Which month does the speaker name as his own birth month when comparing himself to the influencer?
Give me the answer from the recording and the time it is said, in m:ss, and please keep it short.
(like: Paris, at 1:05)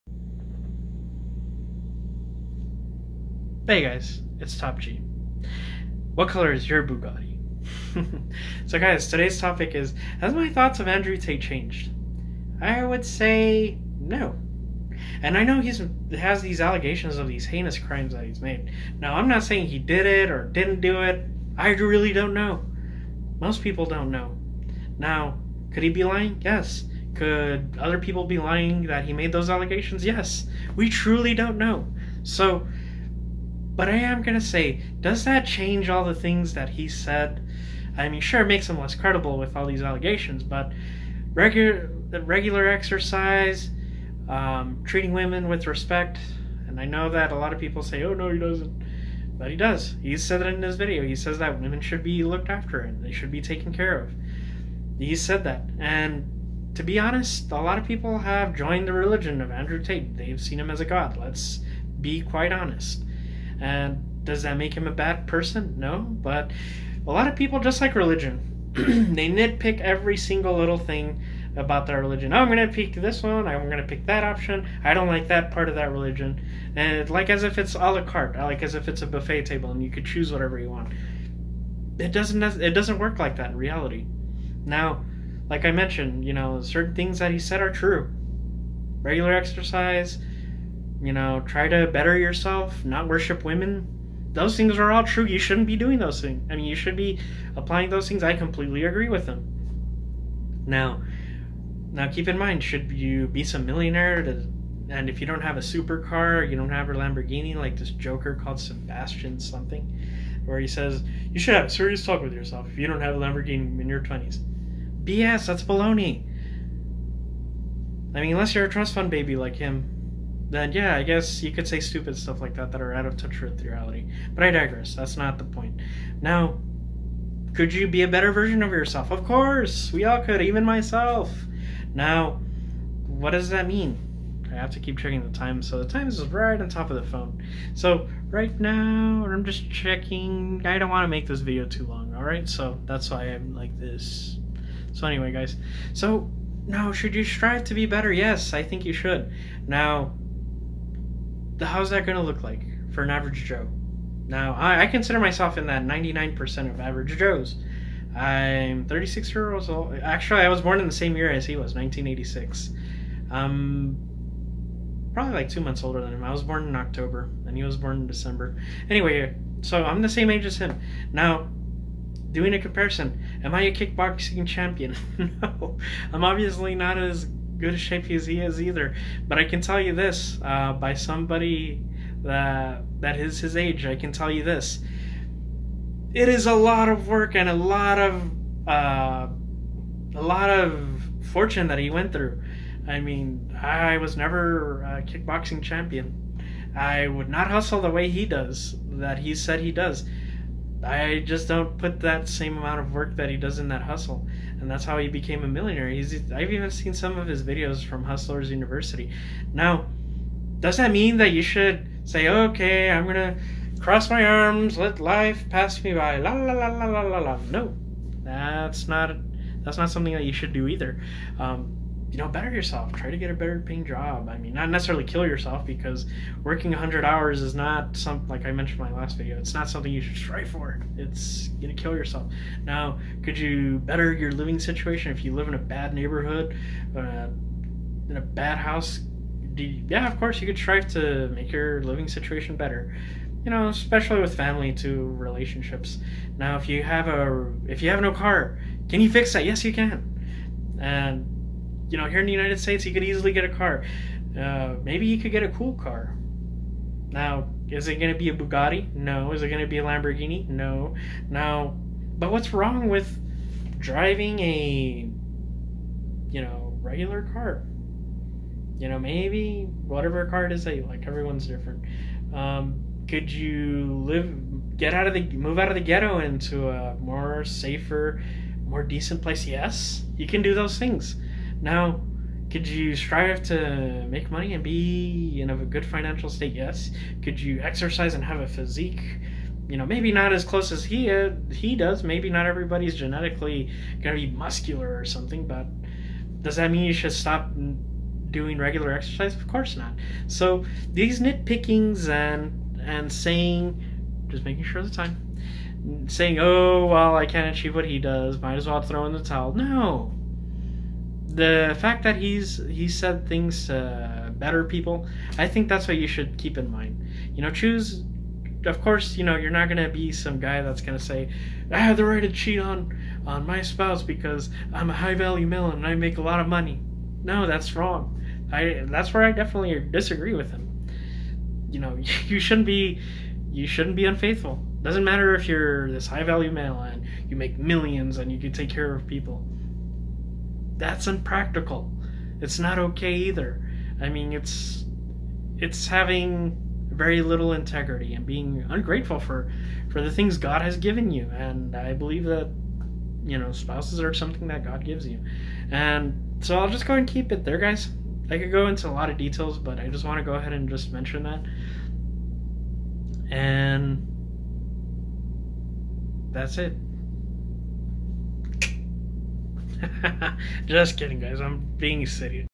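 October, at 2:46.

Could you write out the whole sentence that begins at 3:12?
I mean, I was never a kickboxing champion.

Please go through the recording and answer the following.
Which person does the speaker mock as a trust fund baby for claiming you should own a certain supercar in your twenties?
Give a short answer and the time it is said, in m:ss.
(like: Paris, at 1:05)
Sebastian, at 1:48.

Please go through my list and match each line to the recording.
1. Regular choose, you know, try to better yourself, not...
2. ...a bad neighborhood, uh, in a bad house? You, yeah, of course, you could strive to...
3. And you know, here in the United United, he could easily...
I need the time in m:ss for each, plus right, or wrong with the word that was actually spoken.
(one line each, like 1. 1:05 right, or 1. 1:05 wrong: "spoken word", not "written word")
1. 1:29 wrong: "exercise", not "choose"
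2. 3:55 right
3. 4:10 wrong: "States", not "United".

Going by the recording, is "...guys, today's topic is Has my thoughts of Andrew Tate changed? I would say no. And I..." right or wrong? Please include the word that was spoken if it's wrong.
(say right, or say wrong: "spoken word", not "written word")
right.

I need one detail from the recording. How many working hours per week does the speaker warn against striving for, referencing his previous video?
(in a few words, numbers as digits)
100.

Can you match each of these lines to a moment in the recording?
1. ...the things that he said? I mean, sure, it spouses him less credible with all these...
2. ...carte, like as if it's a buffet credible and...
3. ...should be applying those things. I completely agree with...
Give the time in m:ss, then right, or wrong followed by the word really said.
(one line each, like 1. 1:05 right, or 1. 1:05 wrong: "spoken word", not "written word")
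1. 0:36 wrong: "makes", not "spouses"
2. 1:18 wrong: "table", not "credible"
3. 1:36 right.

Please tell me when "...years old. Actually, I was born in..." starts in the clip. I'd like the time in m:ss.
2:39.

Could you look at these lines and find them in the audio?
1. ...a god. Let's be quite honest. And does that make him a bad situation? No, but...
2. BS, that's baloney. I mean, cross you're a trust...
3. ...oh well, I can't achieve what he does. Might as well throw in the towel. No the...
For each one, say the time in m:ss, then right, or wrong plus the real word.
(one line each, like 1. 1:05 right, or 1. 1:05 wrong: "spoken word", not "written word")
1. 1:00 wrong: "person", not "situation"
2. 1:55 wrong: "unless", not "cross"
3. 5:06 right.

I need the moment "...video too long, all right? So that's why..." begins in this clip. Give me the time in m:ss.
2:21.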